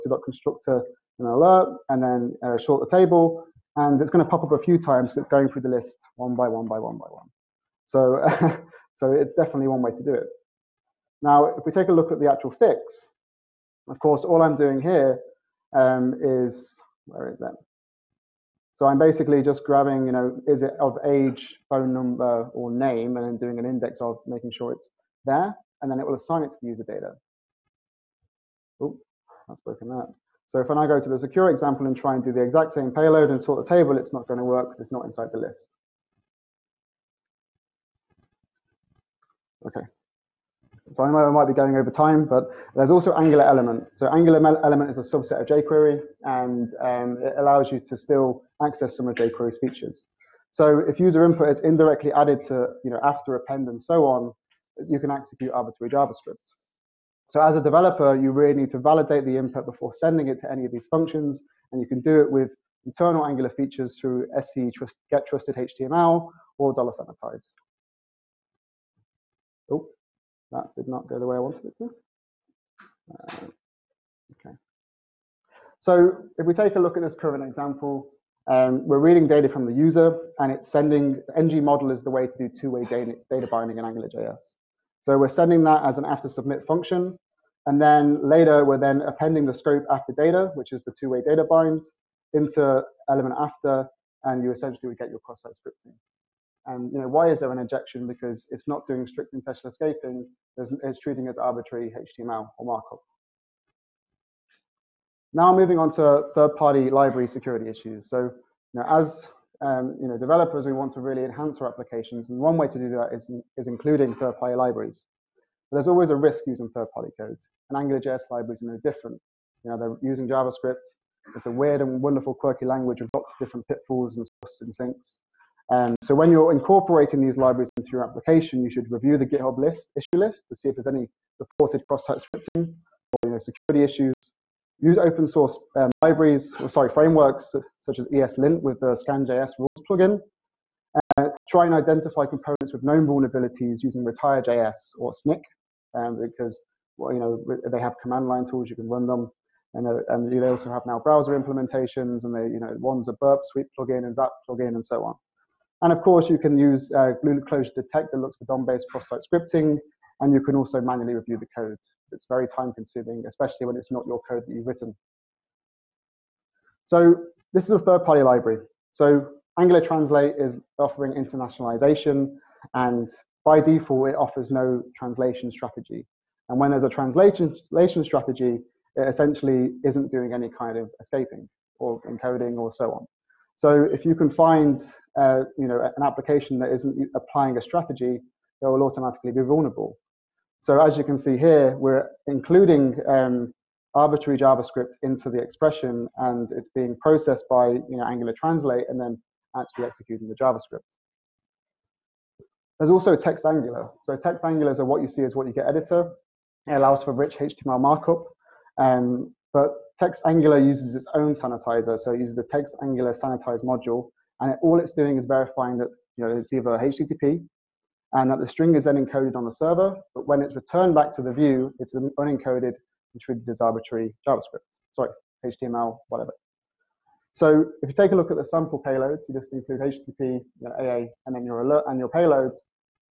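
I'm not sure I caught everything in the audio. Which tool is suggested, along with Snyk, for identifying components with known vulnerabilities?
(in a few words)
Retire.js.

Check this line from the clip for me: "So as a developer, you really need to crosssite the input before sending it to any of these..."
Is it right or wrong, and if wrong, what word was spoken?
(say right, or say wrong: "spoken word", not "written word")
wrong: "validate", not "crosssite".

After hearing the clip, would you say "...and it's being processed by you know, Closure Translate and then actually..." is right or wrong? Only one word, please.
wrong.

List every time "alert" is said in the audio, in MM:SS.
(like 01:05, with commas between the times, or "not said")
00:01, 03:51.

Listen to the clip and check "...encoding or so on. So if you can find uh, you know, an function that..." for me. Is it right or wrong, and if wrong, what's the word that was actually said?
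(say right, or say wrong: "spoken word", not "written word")
wrong: "application", not "function".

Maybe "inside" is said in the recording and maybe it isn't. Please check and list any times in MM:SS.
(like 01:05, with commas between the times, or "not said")
00:35.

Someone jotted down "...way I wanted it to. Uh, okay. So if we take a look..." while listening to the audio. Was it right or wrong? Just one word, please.
right.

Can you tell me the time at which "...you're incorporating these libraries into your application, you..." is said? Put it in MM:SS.
02:06.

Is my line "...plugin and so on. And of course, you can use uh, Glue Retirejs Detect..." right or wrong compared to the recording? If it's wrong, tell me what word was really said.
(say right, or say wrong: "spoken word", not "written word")
wrong: "Closure", not "Retirejs".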